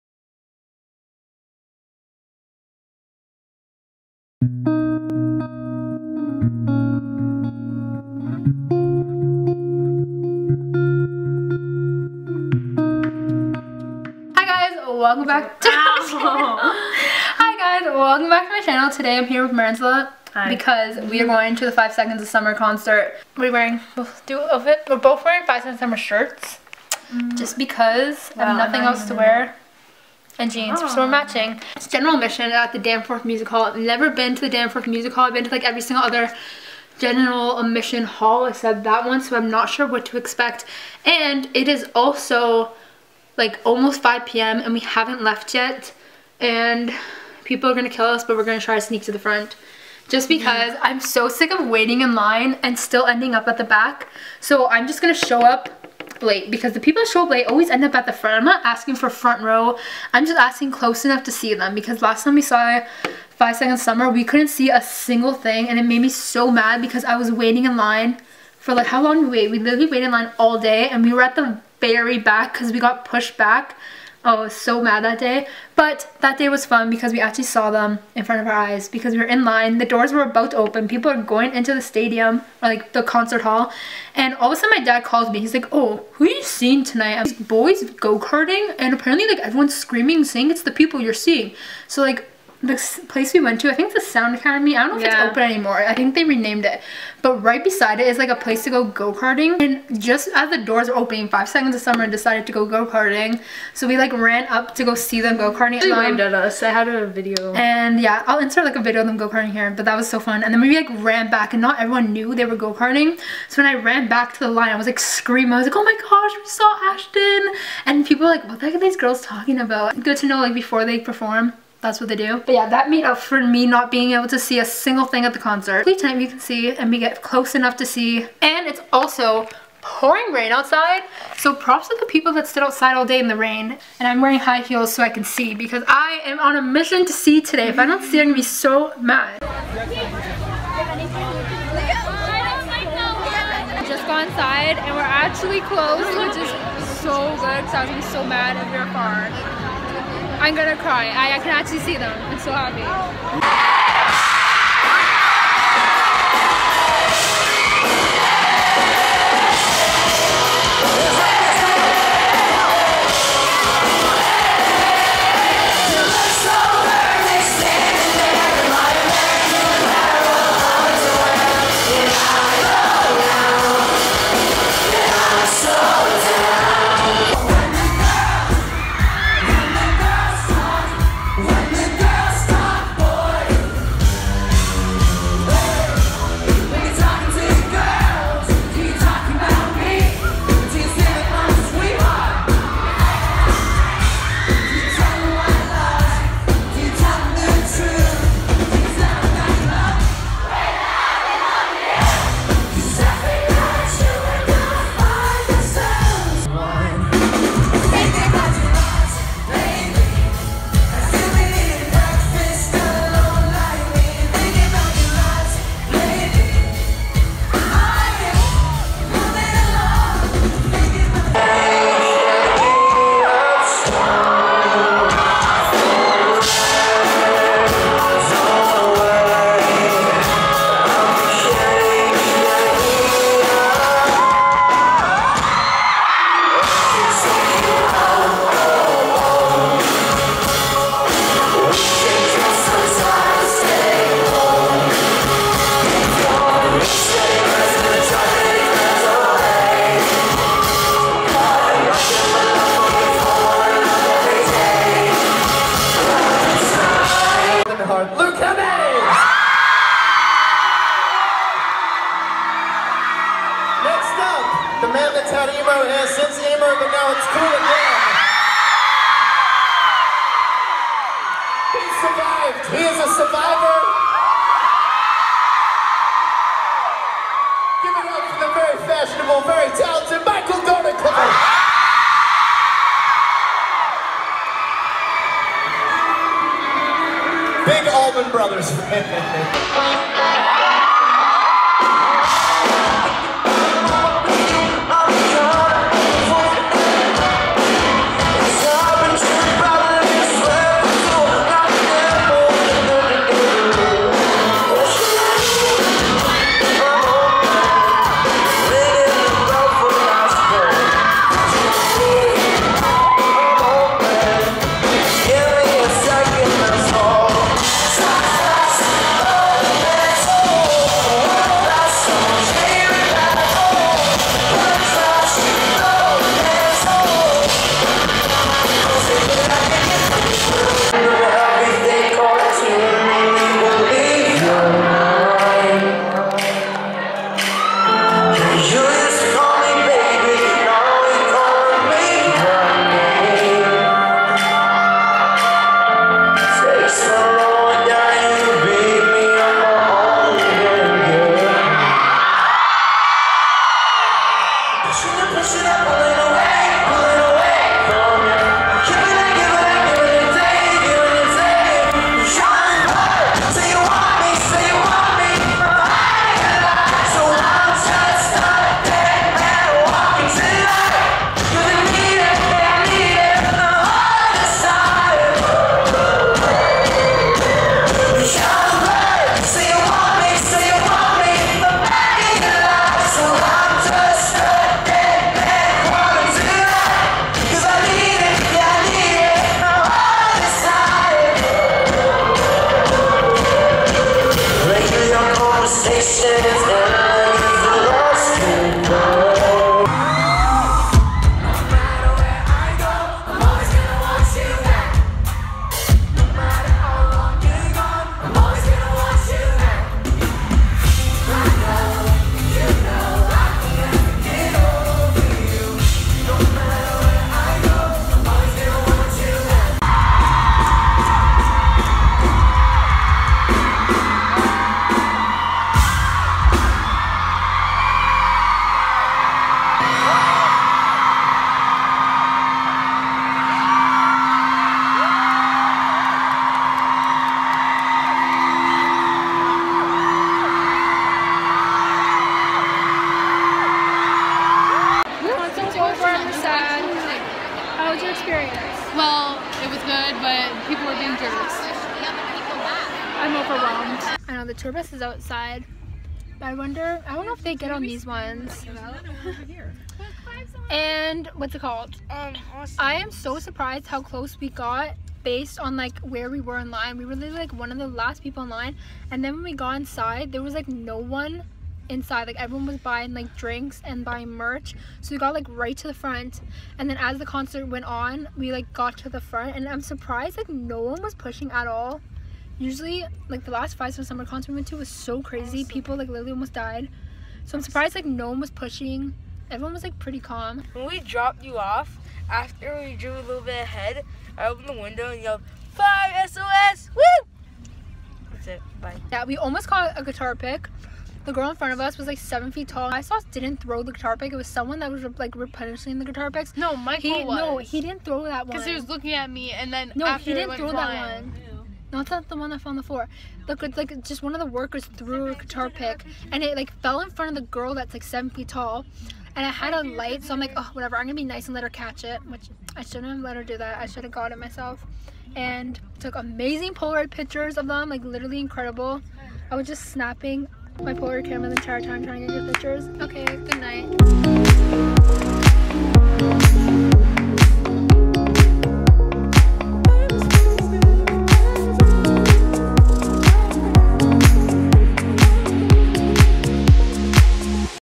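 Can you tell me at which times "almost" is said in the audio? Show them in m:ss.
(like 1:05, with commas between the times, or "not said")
0:43, 8:06, 8:19.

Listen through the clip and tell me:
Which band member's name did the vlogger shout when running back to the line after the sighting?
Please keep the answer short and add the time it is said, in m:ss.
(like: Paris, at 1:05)
Ashton, at 1:56.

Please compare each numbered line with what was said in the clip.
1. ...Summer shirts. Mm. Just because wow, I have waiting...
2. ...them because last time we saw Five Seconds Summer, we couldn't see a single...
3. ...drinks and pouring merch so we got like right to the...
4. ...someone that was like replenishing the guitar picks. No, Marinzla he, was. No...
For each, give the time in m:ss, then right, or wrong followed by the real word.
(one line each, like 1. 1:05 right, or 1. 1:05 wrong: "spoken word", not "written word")
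1. 0:25 wrong: "nothing", not "waiting"
2. 1:01 right
3. 7:53 wrong: "buying", not "pouring"
4. 8:24 wrong: "Michael", not "Marinzla".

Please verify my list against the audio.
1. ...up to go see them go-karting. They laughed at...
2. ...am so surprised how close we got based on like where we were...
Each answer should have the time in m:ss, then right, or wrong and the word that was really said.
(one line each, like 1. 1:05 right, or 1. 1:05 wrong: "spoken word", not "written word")
1. 1:44 right
2. 7:42 right.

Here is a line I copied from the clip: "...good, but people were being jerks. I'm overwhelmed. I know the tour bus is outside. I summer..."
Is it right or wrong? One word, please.
wrong.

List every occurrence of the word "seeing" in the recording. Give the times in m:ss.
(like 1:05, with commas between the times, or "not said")
1:26, 1:31.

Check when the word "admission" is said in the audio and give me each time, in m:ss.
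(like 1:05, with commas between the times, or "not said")
0:32, 0:37.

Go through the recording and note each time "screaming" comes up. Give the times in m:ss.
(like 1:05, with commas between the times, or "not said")
1:29, 1:54.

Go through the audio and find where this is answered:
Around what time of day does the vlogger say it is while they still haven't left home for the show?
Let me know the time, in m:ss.
0:44.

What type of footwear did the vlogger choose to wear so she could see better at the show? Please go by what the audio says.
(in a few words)
High heels.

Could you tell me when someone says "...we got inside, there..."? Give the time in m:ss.
7:49.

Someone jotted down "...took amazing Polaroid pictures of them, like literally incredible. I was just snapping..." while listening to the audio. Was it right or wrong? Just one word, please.
right.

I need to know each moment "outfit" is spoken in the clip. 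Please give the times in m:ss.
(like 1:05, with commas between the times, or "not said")
0:24.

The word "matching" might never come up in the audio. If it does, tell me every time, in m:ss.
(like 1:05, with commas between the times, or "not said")
0:31.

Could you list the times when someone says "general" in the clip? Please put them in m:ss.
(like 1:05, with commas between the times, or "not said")
0:31, 0:36.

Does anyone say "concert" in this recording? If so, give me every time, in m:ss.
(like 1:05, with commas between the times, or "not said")
0:22, 1:23, 2:05, 7:57, 8:04.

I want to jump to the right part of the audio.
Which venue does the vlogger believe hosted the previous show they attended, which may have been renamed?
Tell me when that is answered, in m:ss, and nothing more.
1:34.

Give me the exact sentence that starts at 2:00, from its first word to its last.
Good to know like before they perform that's what they do.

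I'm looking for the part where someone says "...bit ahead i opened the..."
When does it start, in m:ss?
8:13.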